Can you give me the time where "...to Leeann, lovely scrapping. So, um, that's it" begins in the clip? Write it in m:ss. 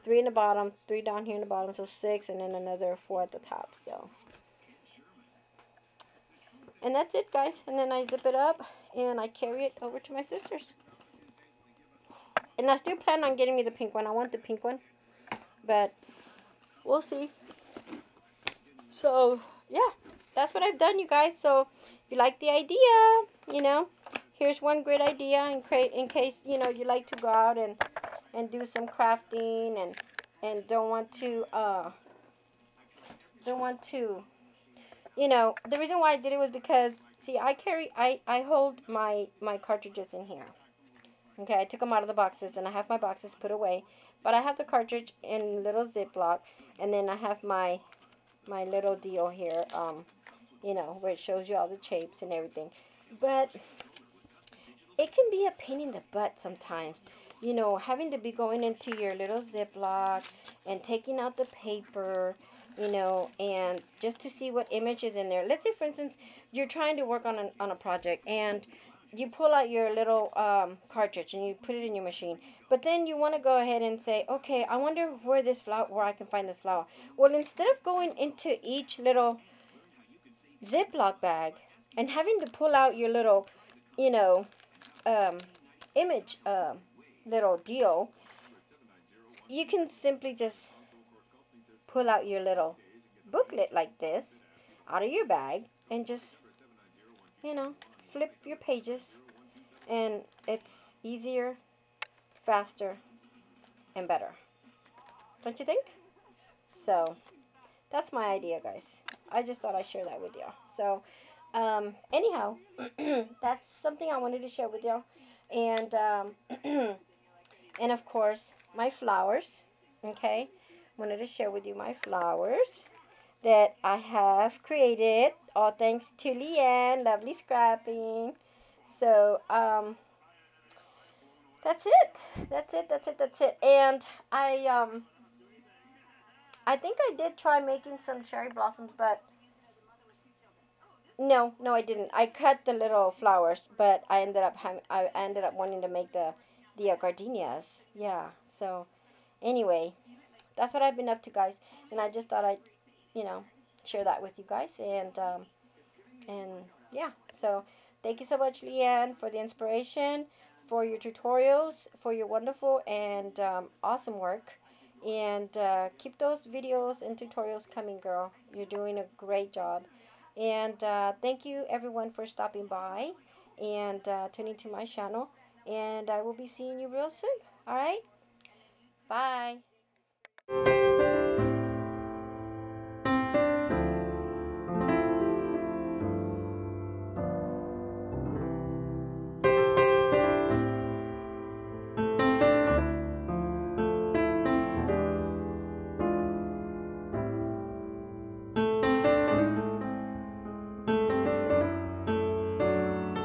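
2:06.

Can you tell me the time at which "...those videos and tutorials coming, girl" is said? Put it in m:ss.
2:46.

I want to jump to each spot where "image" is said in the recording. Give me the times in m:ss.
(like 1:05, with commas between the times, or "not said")
1:04, 1:25.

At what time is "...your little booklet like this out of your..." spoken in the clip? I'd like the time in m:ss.
1:32.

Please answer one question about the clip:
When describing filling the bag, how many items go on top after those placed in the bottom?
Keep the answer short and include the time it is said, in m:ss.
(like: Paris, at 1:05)
4, at 0:03.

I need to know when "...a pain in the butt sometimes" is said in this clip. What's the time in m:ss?
0:55.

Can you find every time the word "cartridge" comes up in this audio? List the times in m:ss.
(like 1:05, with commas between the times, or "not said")
0:39, 0:44, 1:10.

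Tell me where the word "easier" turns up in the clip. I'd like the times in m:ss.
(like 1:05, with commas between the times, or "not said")
1:41.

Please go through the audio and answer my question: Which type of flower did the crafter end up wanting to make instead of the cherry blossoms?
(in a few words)
Gardenias.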